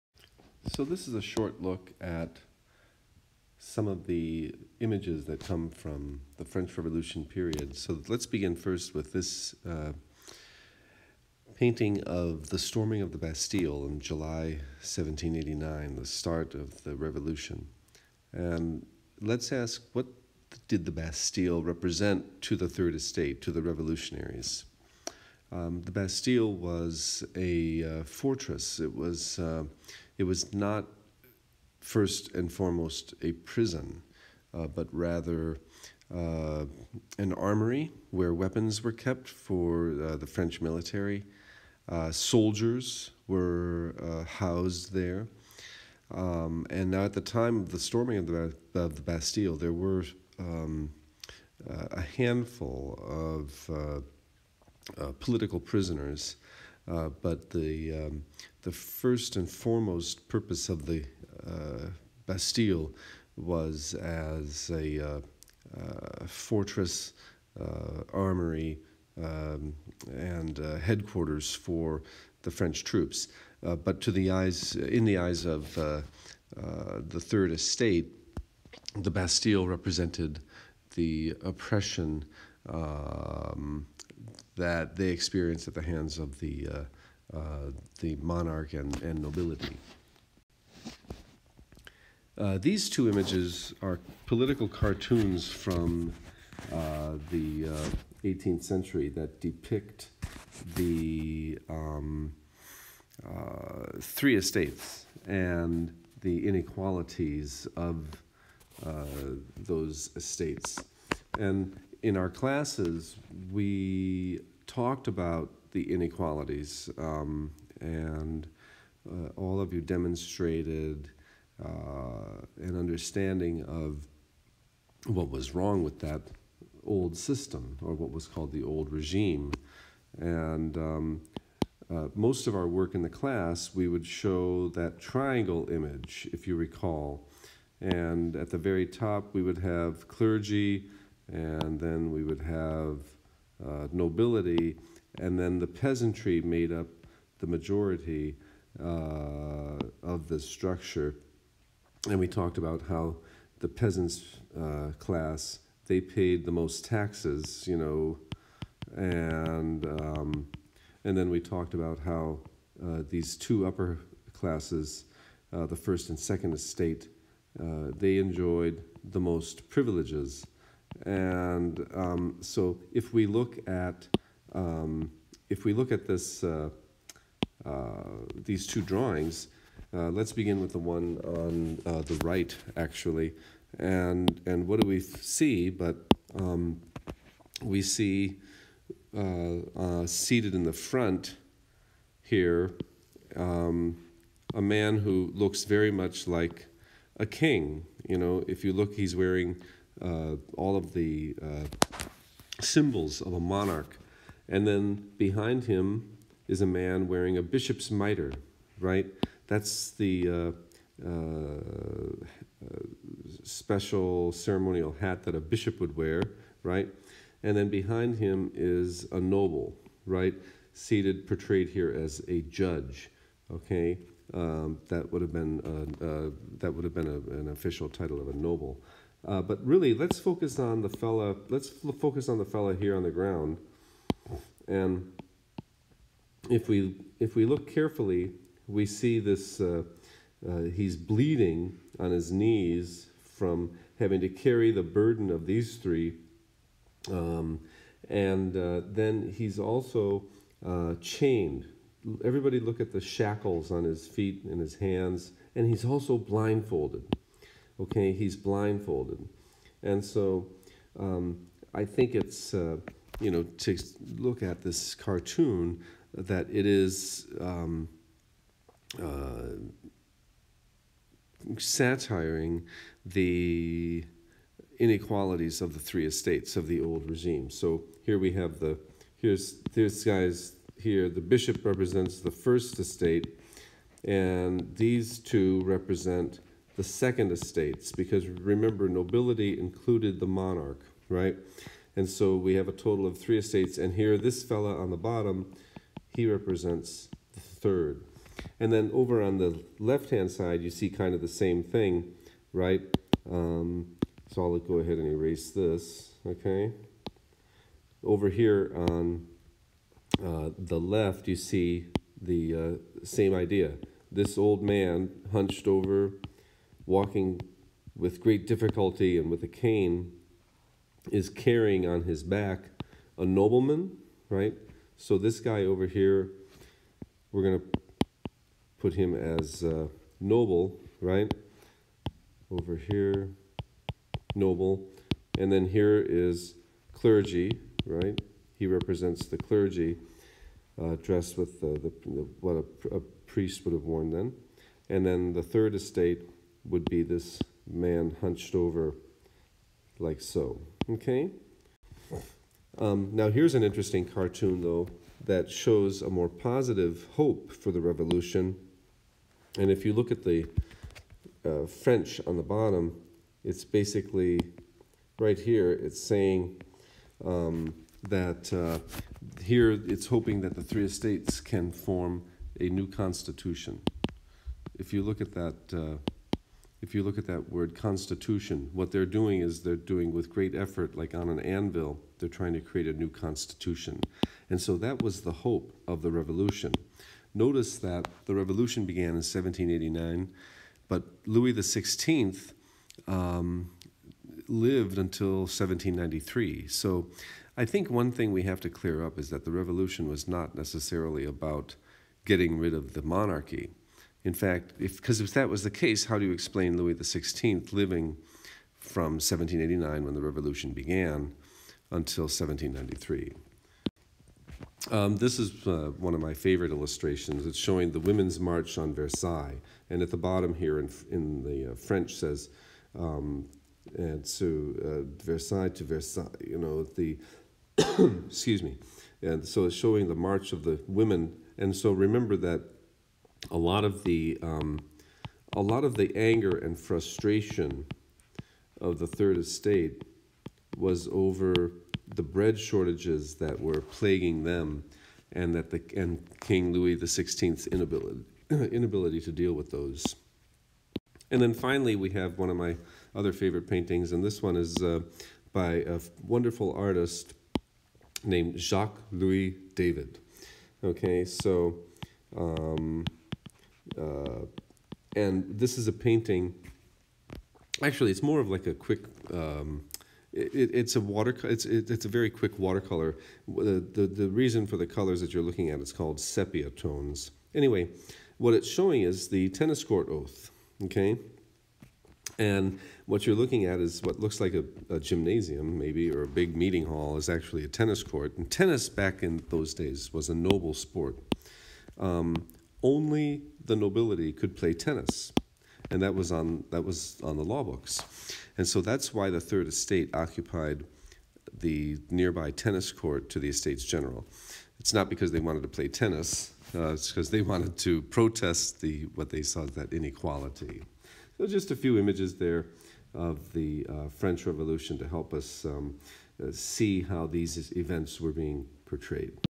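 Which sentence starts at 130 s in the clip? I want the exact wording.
And um, uh, most of our work in the class, we would show that triangle image, if you recall.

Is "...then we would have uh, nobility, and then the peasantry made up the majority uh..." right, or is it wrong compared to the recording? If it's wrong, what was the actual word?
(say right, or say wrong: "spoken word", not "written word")
right.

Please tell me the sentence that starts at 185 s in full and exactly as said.
But um, we see uh, uh, seated in the front here um, a man who looks very much like a king.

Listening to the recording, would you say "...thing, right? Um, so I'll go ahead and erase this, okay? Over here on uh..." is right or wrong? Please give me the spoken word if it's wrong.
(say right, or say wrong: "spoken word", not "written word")
right.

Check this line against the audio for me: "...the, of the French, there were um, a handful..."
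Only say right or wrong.
wrong.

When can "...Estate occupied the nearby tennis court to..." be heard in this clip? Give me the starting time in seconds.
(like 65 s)
499 s.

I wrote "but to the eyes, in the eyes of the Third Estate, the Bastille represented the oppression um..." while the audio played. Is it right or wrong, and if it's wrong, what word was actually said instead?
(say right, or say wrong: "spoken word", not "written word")
right.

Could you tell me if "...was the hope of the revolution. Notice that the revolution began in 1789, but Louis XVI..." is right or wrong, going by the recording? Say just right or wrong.
right.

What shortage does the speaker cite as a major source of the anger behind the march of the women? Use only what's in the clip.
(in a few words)
bread shortages.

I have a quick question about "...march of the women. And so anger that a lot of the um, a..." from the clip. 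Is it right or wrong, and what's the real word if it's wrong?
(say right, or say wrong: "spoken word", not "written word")
wrong: "remember", not "anger".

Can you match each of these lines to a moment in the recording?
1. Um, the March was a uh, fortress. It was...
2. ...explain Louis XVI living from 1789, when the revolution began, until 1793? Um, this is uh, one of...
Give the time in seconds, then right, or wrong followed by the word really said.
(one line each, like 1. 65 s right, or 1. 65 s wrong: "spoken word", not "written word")
1. 25 s wrong: "Bastille", not "March"
2. 406 s right.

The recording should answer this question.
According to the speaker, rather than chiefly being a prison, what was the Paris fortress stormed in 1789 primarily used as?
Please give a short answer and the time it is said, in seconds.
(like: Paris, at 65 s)
an armory, at 37 s.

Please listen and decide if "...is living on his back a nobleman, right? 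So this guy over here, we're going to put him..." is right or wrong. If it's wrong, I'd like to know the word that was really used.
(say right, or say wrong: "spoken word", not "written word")
wrong: "carrying", not "living".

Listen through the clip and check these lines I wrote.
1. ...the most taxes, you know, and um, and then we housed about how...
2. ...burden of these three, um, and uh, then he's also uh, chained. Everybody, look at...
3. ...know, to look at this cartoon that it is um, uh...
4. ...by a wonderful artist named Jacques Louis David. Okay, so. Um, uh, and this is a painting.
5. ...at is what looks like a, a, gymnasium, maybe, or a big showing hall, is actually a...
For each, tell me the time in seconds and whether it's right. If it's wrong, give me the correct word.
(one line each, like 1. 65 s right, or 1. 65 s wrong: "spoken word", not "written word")
1. 156 s wrong: "talked", not "housed"
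2. 244 s right
3. 263 s right
4. 455 s right
5. 483 s wrong: "meeting", not "showing".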